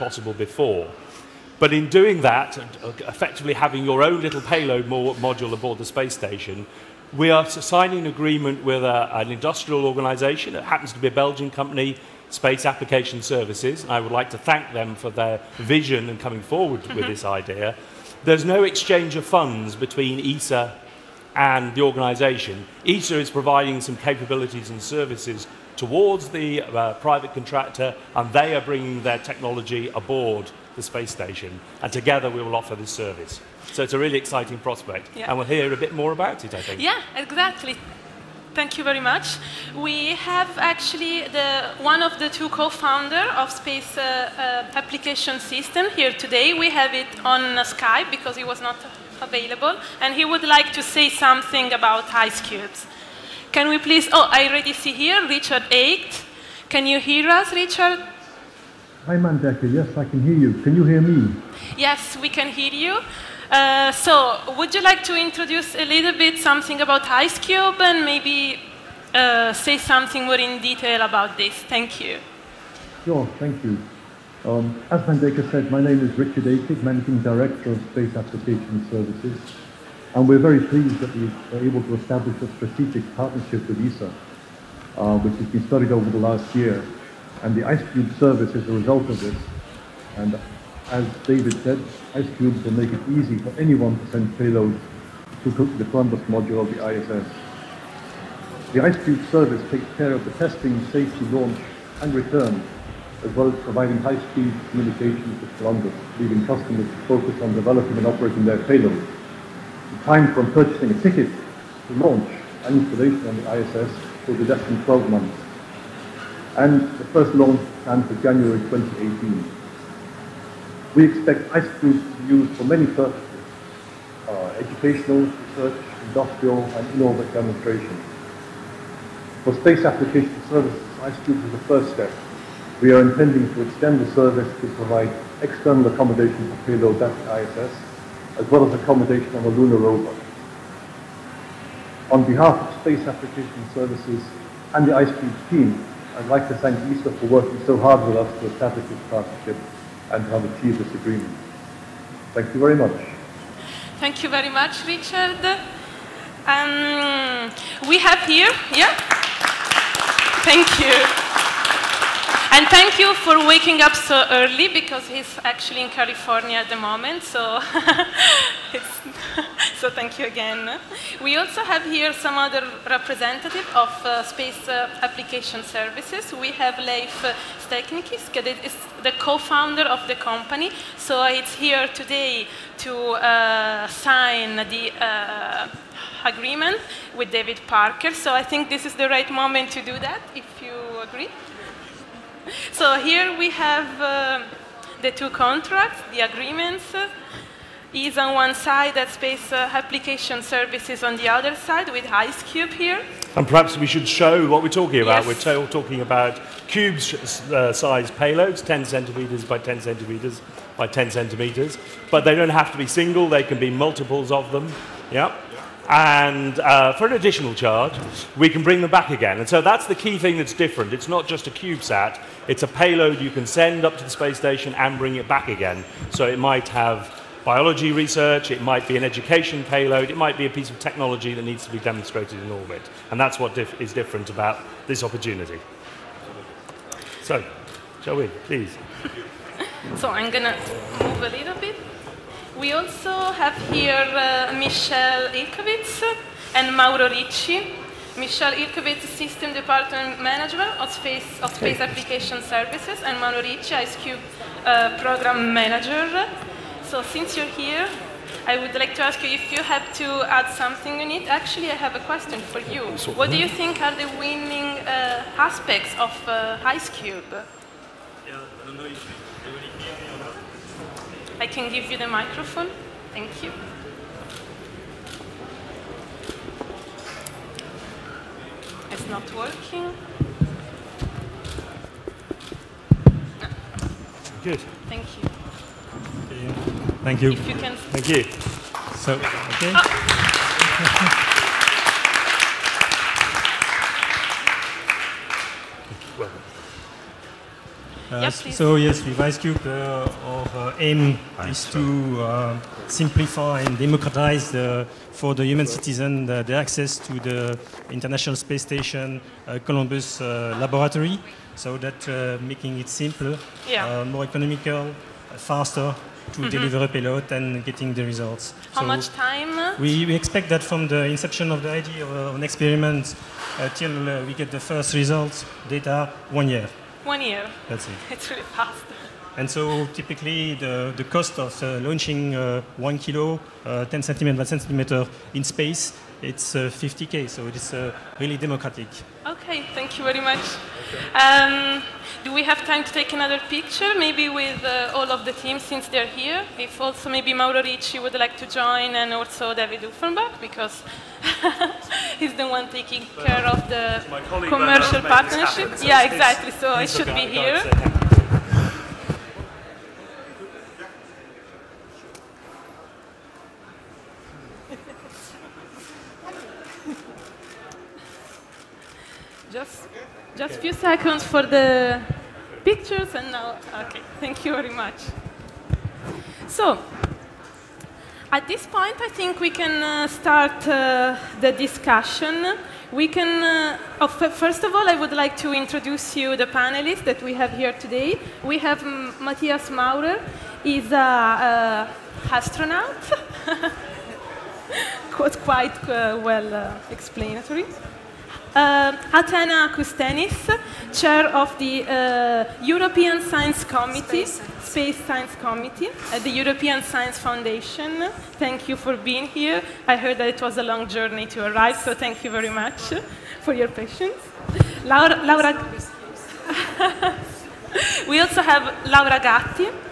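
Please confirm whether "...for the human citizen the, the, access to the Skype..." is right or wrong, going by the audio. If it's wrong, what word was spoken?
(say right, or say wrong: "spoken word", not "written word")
wrong: "International", not "Skype".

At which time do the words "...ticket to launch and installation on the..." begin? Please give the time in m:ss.
1:51.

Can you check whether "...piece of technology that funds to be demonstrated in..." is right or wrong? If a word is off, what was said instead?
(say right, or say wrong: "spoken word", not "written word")
wrong: "needs", not "funds".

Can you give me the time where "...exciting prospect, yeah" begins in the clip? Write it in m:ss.
0:34.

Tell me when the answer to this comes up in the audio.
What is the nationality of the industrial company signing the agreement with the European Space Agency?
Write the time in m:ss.
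0:11.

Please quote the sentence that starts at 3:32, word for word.
But they don't have to be single, they can be multiples of them.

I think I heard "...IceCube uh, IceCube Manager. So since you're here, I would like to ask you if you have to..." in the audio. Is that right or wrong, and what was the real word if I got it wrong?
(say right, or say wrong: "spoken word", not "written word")
wrong: "Program", not "IceCube".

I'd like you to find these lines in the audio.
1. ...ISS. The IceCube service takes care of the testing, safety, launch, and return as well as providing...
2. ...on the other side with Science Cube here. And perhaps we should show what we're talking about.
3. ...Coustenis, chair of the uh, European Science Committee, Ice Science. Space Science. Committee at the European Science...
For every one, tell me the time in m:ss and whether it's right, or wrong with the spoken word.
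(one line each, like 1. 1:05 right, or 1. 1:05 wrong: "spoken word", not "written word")
1. 1:36 right
2. 3:21 wrong: "Ice", not "Science"
3. 6:39 wrong: "Space", not "Ice".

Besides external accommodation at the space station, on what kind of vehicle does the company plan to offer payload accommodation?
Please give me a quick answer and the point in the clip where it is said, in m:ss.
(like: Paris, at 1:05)
lunar rover, at 2:19.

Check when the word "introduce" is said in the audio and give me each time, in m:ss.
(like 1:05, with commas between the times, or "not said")
1:05, 6:25.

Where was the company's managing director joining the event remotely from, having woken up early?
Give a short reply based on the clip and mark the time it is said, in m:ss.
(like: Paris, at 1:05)
California, at 2:45.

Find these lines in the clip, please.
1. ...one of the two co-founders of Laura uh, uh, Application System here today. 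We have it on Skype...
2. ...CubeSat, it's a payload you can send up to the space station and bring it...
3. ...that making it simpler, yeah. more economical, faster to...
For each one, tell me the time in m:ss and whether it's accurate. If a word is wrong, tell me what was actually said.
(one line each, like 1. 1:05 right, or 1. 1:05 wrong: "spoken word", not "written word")
1. 0:41 wrong: "Space", not "Laura"
2. 3:41 right
3. 5:11 right.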